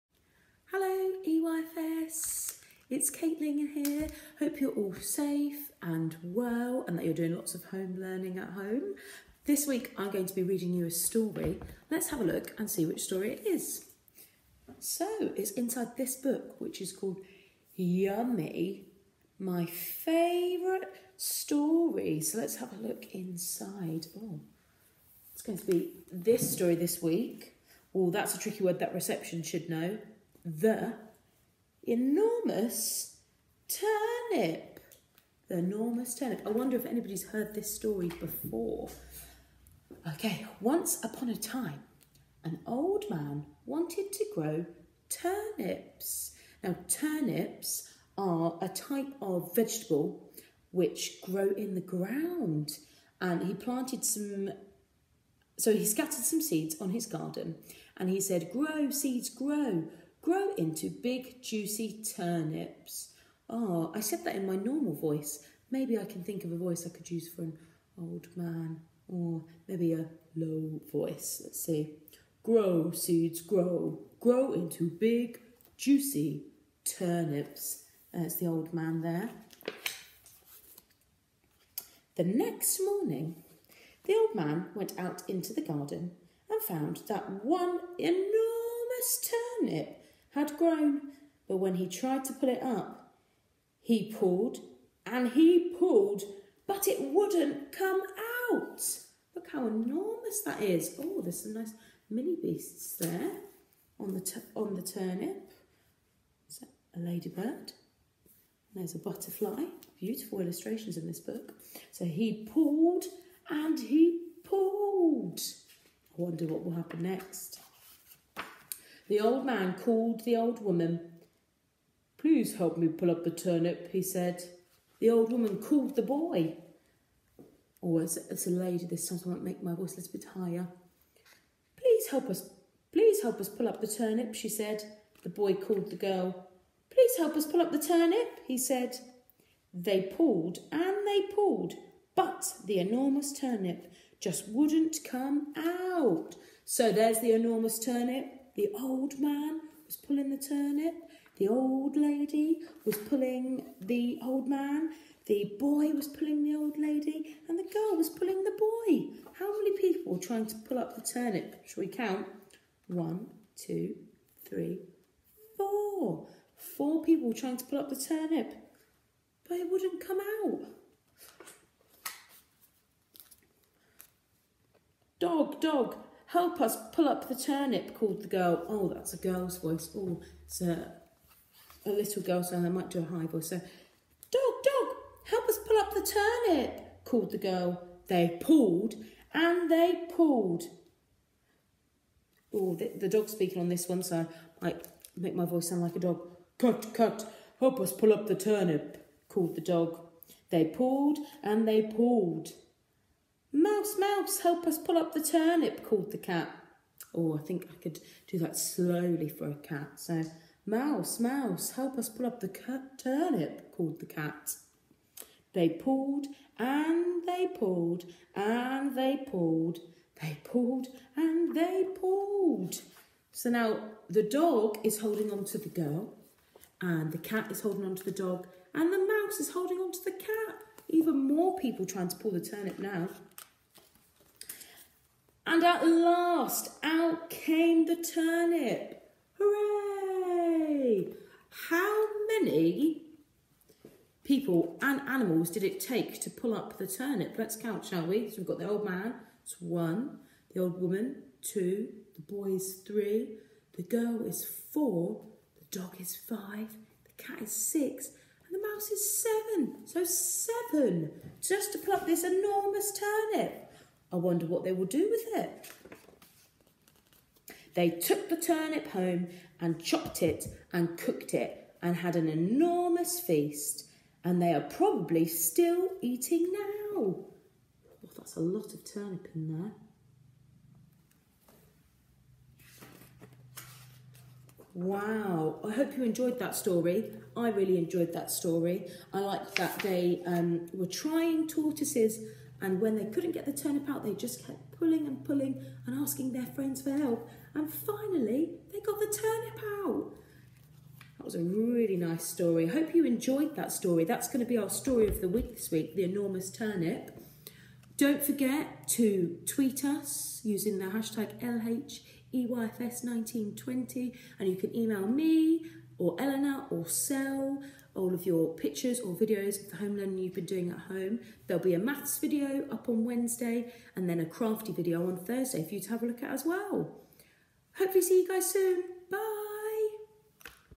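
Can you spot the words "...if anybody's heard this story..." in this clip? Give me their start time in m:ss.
0:36.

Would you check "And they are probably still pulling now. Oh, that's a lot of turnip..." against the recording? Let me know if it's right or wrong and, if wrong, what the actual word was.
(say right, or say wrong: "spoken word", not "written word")
wrong: "eating", not "pulling".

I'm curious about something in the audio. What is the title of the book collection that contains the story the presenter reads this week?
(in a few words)
Yummy.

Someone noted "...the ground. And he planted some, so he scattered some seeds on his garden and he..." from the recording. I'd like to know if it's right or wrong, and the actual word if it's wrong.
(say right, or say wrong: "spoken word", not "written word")
right.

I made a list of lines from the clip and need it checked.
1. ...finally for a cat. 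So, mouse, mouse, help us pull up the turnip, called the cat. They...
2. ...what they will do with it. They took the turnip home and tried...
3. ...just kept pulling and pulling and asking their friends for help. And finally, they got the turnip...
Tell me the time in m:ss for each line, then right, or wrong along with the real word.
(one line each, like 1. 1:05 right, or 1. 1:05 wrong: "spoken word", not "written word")
1. 3:28 wrong: "slowly", not "finally"
2. 4:24 wrong: "chopped", not "tried"
3. 4:54 right.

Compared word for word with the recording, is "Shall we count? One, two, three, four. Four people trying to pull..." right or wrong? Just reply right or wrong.
right.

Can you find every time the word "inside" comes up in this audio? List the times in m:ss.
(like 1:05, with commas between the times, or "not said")
0:15, 0:23.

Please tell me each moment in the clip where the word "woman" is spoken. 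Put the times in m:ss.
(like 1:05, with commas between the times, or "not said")
2:00, 2:05, 4:10.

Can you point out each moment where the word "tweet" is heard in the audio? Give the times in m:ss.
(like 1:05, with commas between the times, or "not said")
5:09.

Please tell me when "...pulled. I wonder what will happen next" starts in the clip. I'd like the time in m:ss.
1:54.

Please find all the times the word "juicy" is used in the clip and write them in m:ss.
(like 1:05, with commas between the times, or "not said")
1:01, 1:15.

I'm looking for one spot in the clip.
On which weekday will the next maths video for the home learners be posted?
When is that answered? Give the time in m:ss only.
5:23.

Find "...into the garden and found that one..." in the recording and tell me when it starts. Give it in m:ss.
1:25.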